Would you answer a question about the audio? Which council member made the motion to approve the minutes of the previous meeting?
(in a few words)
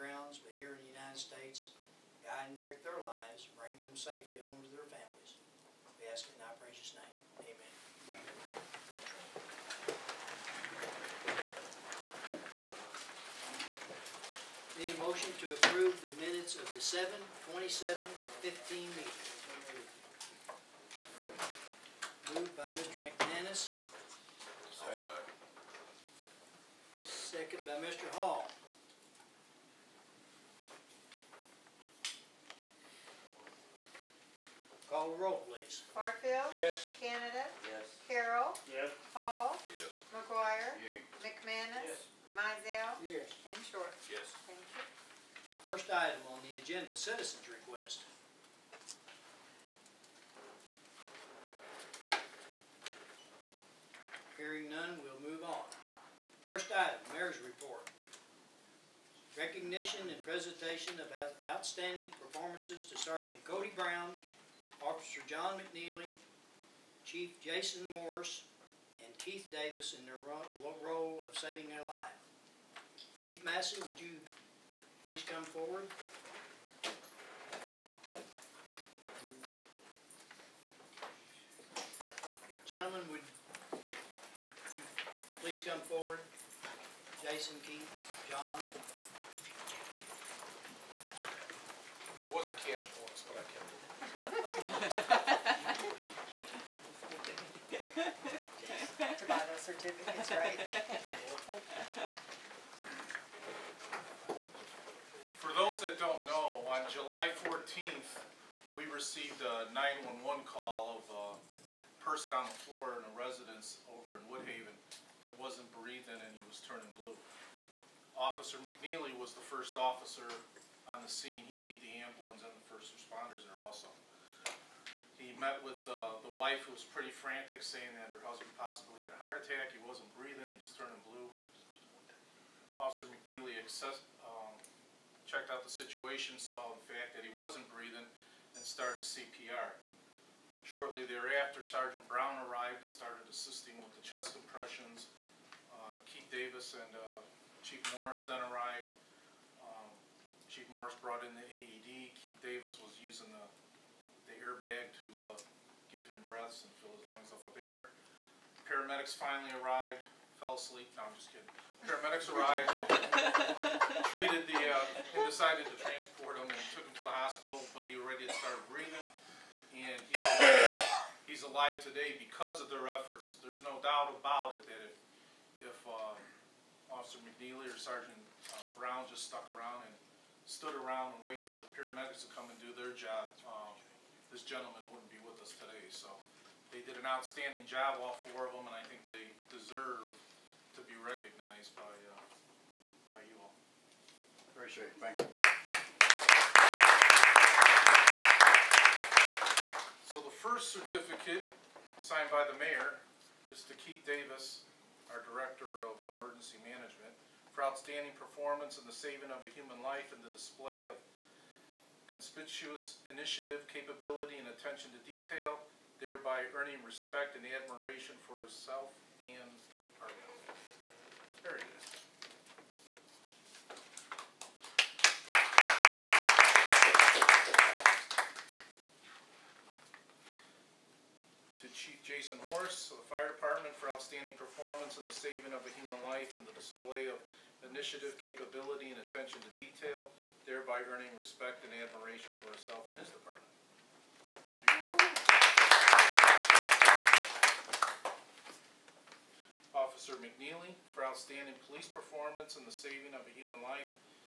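Mr. McManus.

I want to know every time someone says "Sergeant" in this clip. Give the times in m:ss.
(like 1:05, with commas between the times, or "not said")
1:02, 2:21, 2:57.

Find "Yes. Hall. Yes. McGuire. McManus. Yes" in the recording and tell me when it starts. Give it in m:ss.
0:38.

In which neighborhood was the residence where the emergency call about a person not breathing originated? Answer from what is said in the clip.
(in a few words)
Woodhaven.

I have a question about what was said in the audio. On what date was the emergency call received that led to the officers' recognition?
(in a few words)
July 14th.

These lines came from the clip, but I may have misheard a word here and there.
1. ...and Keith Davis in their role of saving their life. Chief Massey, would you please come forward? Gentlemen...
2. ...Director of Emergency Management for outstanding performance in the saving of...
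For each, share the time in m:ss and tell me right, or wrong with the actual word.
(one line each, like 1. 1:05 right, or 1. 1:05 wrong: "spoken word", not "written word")
1. 1:09 right
2. 3:25 right.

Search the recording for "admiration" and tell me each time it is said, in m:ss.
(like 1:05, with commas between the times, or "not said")
3:37, 4:01.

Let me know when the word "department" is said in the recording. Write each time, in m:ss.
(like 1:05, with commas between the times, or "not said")
3:39, 3:53, 4:03.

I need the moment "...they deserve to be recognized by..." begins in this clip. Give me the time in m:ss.
3:09.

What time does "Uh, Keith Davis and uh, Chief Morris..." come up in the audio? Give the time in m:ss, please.
2:25.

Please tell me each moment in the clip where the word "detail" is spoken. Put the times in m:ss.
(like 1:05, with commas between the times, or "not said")
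3:35, 3:59.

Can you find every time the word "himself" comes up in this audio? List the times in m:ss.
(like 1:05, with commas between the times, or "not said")
3:38.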